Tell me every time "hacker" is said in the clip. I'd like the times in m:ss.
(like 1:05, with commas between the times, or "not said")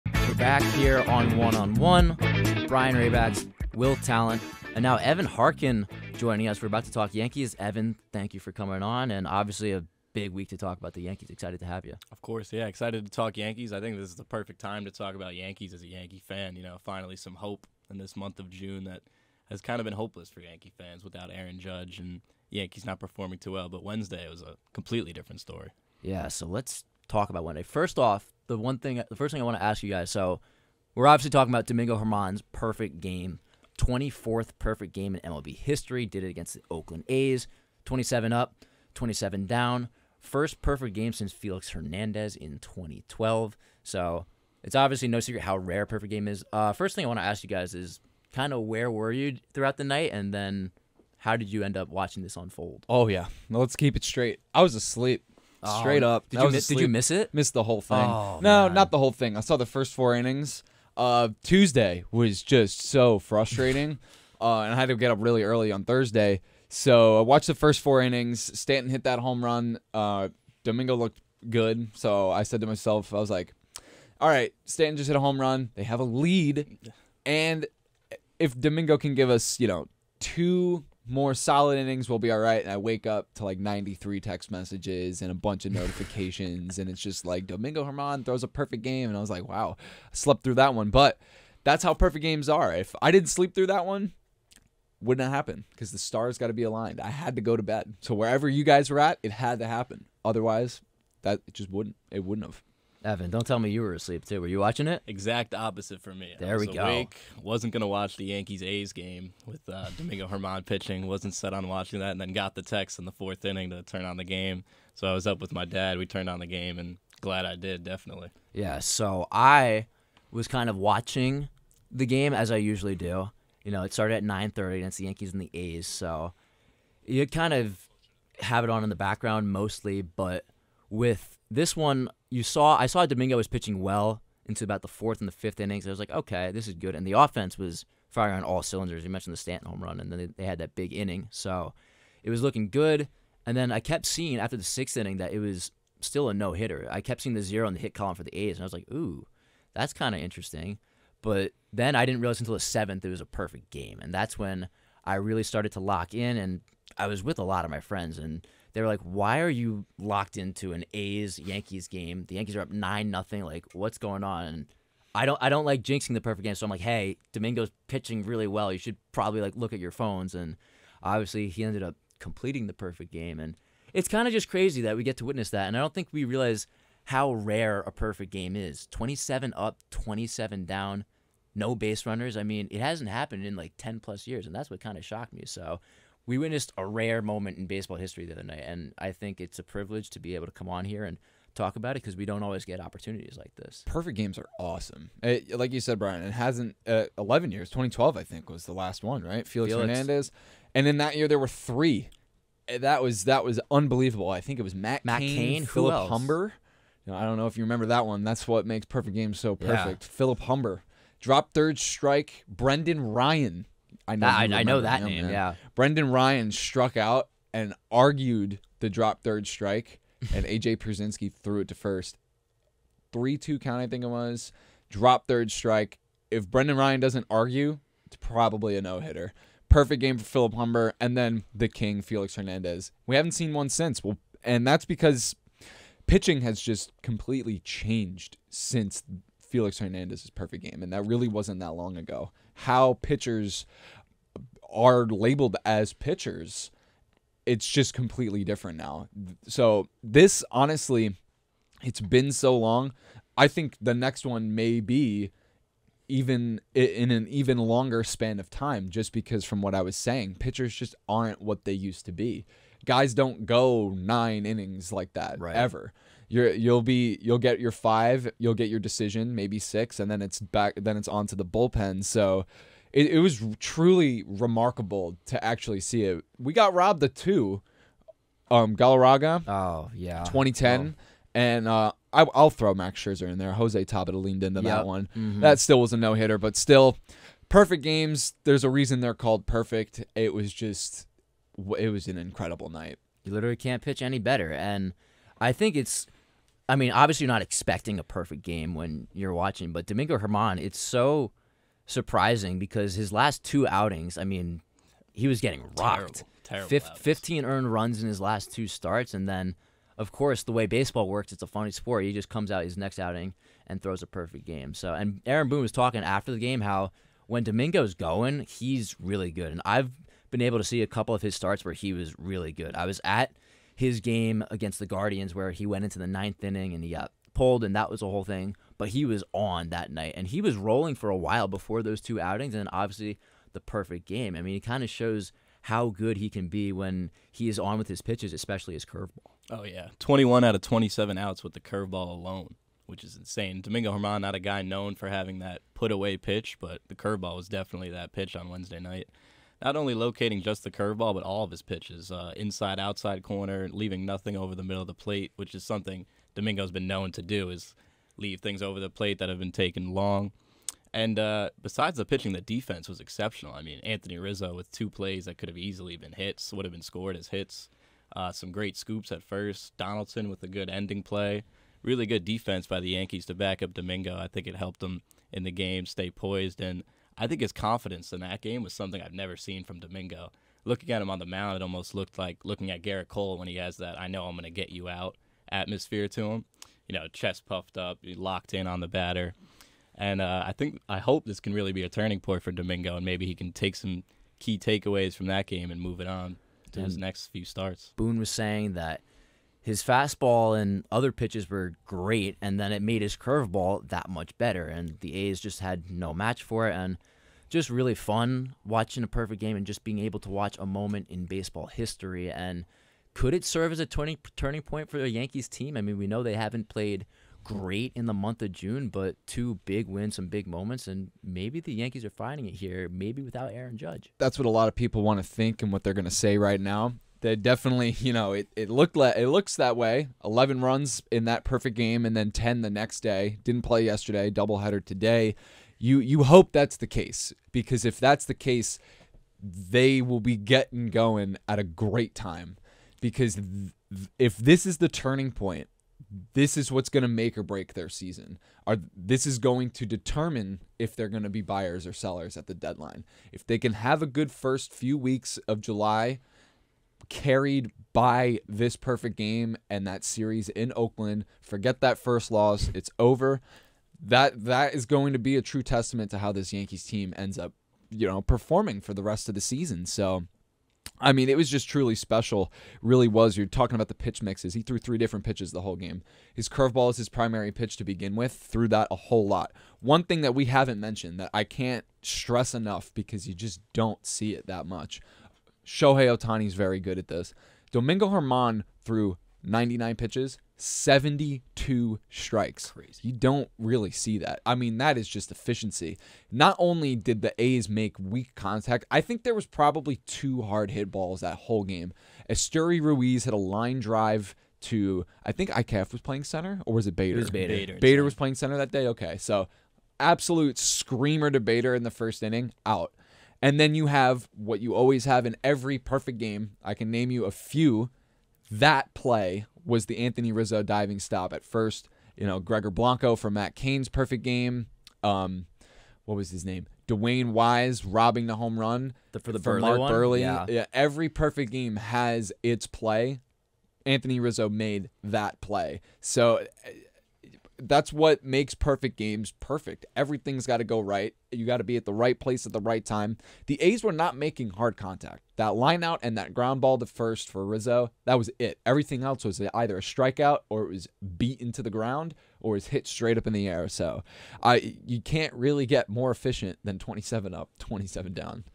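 not said.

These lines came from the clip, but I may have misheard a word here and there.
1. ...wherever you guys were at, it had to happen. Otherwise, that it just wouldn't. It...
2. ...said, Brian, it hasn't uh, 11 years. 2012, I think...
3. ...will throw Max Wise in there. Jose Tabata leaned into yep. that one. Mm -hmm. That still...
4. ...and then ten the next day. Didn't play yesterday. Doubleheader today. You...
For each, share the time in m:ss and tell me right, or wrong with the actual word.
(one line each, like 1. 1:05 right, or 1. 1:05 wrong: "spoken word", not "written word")
1. 1:38 right
2. 3:15 right
3. 4:42 wrong: "Scherzer", not "Wise"
4. 7:12 right.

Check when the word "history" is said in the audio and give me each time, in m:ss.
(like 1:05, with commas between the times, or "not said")
0:35, 3:07, 6:51.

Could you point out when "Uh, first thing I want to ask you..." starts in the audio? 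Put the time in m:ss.
0:46.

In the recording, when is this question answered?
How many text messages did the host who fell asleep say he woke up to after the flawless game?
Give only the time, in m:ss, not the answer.
1:23.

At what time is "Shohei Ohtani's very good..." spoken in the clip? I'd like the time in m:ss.
8:05.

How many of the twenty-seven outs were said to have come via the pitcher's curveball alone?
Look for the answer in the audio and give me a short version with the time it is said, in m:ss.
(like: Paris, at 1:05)
21, at 5:39.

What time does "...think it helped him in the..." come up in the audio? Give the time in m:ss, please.
6:14.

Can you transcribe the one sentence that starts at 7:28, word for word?
Are this is going to determine if they're going to be buyers or sellers at the deadline.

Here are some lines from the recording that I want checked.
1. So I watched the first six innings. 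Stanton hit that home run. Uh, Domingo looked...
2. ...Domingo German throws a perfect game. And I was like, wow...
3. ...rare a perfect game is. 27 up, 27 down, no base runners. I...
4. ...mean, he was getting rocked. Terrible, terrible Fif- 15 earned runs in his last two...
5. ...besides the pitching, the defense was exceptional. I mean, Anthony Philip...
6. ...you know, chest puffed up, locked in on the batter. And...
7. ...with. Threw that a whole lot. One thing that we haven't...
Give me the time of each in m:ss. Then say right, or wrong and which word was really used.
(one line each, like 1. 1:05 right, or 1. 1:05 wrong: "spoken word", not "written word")
1. 1:06 wrong: "four", not "six"
2. 1:27 right
3. 2:57 right
4. 5:04 right
5. 6:01 wrong: "Rizzo", not "Philip"
6. 6:26 right
7. 7:58 right.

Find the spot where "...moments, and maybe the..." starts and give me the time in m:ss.
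7:00.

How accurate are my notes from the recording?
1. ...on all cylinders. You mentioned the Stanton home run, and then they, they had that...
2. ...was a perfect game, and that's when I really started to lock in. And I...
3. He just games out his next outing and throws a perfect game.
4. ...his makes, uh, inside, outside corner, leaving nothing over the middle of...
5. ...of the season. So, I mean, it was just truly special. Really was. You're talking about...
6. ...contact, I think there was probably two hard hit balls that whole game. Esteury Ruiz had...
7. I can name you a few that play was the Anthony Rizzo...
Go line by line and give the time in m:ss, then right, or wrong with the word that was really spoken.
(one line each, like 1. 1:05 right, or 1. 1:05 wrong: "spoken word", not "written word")
1. 2:18 right
2. 2:33 right
3. 5:12 wrong: "comes", not "games"
4. 5:51 wrong: "pitches", not "makes"
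5. 7:49 right
6. 8:18 right
7. 8:36 right.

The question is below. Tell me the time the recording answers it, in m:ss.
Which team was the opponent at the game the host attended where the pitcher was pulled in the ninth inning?
5:24.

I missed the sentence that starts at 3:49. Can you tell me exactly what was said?
Perfect game for Philip Humber, and then the king Felix Hernandez.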